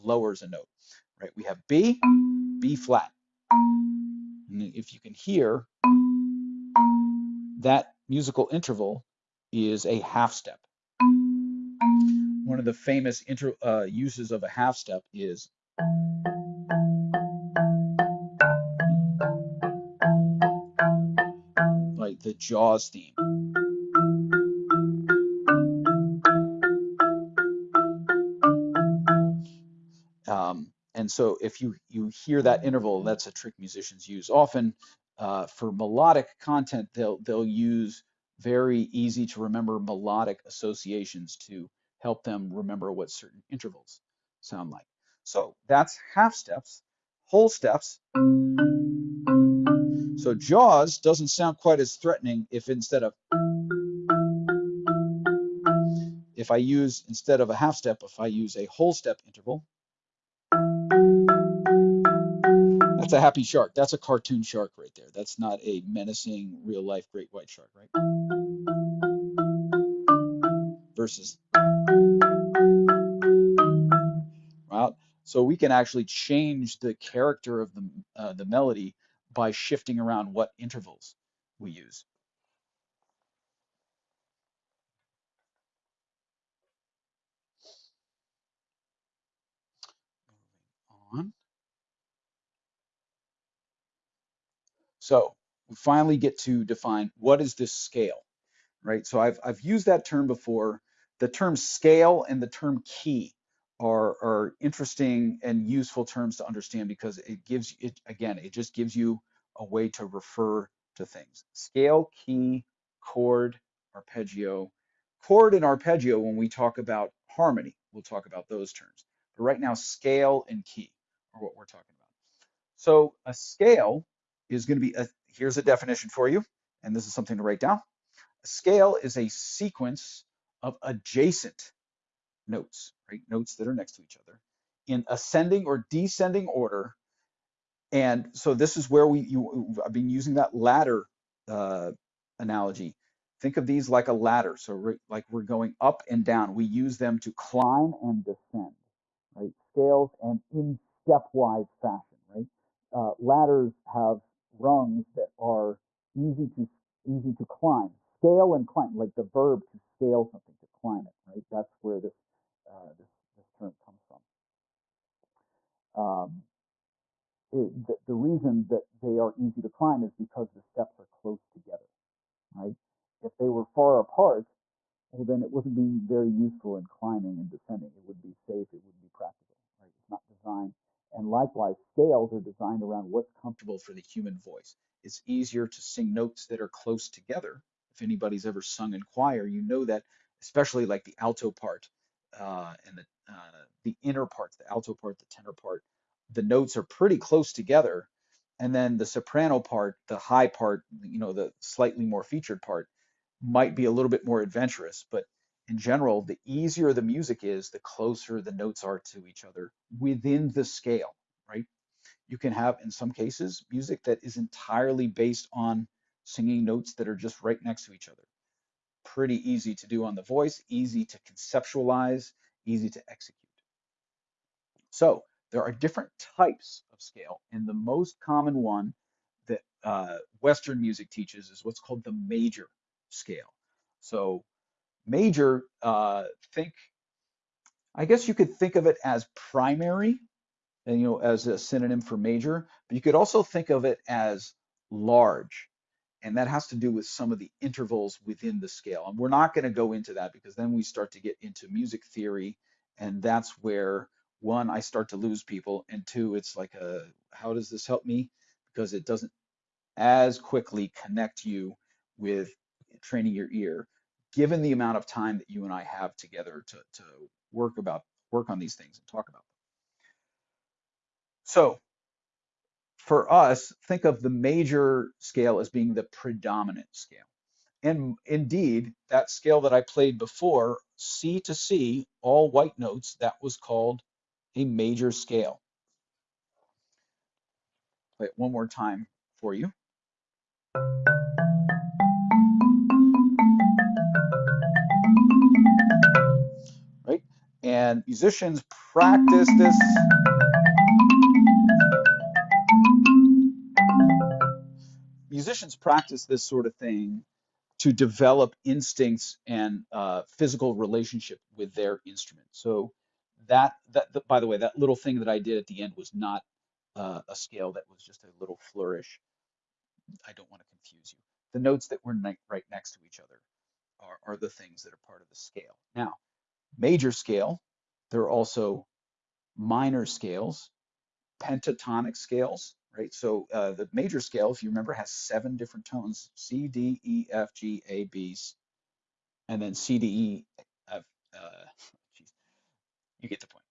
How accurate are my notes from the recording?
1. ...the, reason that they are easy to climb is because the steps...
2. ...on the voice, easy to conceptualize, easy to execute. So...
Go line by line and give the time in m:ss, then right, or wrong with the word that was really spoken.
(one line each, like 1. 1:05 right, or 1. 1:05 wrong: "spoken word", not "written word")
1. 2:48 right
2. 3:40 right.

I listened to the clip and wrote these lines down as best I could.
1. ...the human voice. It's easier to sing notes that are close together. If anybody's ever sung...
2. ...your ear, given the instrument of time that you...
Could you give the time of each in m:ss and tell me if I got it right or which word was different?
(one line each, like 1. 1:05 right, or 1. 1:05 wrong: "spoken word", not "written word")
1. 3:03 right
2. 4:23 wrong: "amount", not "instrument".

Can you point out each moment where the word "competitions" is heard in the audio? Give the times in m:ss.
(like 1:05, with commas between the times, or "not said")
not said.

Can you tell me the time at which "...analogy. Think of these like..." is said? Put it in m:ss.
2:22.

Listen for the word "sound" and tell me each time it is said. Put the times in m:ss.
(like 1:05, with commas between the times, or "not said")
0:44, 0:51.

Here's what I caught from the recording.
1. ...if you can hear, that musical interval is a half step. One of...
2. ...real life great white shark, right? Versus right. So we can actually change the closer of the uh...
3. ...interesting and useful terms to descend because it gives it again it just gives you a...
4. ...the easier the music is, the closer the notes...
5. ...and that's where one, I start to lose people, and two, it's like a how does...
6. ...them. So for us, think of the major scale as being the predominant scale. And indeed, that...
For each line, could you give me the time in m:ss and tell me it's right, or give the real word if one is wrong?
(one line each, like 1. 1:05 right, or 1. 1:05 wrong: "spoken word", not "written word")
1. 0:04 right
2. 1:06 wrong: "character", not "closer"
3. 1:44 wrong: "understand", not "descend"
4. 3:26 right
5. 4:12 right
6. 4:29 right.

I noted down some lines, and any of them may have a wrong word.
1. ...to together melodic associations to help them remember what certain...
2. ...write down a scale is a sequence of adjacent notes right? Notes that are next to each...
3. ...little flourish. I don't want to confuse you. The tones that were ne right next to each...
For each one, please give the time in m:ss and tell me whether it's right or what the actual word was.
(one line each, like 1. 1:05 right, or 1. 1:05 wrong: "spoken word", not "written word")
1. 0:39 wrong: "remember", not "together"
2. 2:07 right
3. 5:18 wrong: "notes", not "tones".